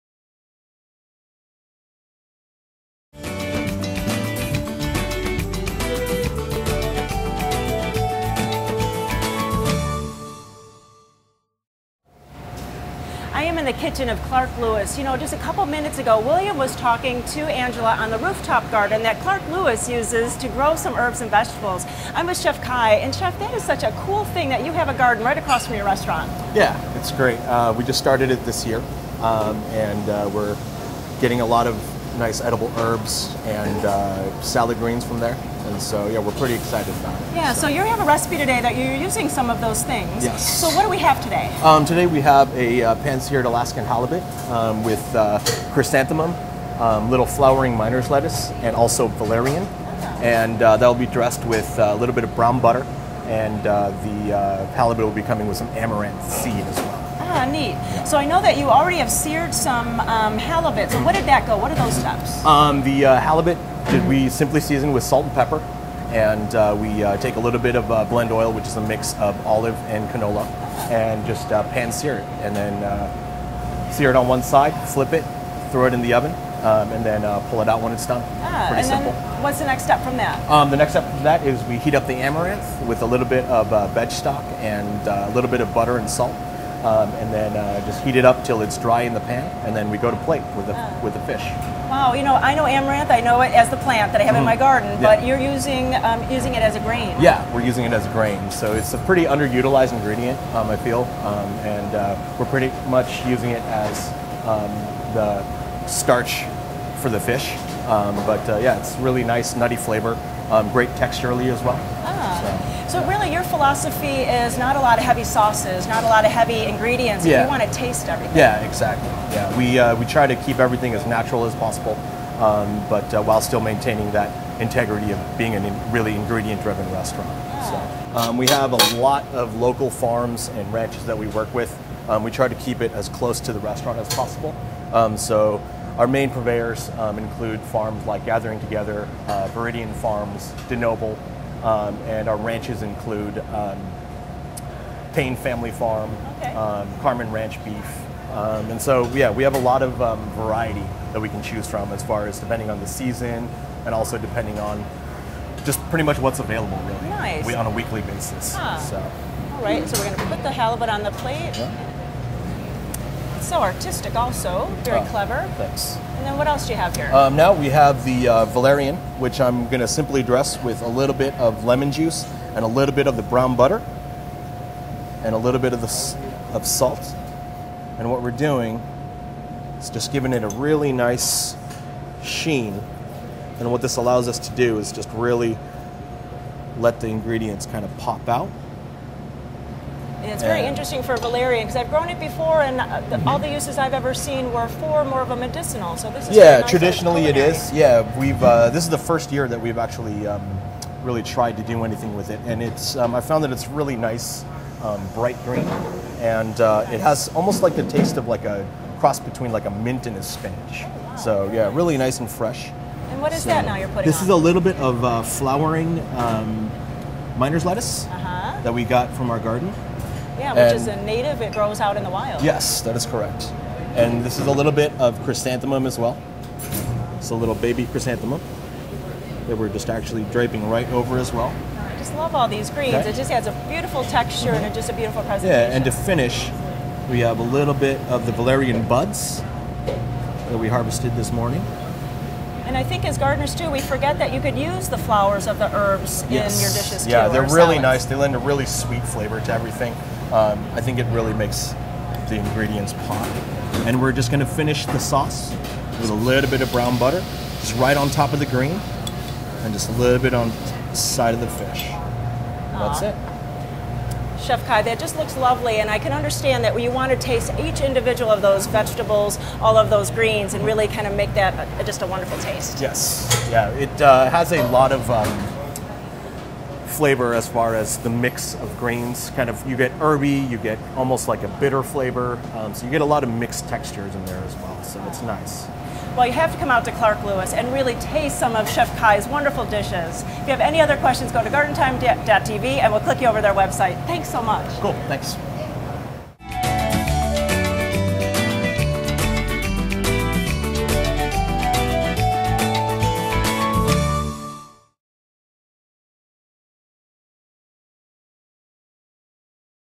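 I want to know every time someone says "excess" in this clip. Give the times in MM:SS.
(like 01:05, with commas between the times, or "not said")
not said.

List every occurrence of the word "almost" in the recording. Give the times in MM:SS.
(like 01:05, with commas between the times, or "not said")
03:27, 04:40.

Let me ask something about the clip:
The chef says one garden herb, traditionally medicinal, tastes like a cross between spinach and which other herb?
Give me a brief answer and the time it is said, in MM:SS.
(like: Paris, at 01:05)
mint, at 03:29.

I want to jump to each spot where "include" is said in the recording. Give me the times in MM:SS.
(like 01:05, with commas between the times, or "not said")
02:17, 02:22.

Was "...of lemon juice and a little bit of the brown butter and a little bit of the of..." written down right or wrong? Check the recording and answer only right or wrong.
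right.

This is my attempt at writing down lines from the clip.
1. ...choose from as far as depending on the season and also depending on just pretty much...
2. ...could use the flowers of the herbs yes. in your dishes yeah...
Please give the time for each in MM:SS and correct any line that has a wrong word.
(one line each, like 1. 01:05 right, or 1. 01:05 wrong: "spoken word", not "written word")
1. 02:31 right
2. 04:04 right.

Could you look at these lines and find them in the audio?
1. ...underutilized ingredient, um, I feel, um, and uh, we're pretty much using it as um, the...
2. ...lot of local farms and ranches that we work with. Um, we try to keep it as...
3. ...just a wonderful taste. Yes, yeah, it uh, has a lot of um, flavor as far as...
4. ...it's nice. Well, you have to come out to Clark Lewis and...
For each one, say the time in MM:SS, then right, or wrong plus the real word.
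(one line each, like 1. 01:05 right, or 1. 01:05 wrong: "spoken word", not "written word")
1. 01:39 right
2. 02:08 right
3. 04:31 right
4. 04:45 right.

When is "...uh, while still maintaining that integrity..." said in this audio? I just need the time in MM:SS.
02:03.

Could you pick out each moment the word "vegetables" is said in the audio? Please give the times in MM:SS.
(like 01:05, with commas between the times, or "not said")
00:21, 04:28.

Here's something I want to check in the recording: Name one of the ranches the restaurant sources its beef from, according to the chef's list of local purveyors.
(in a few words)
Carman Ranch Beef.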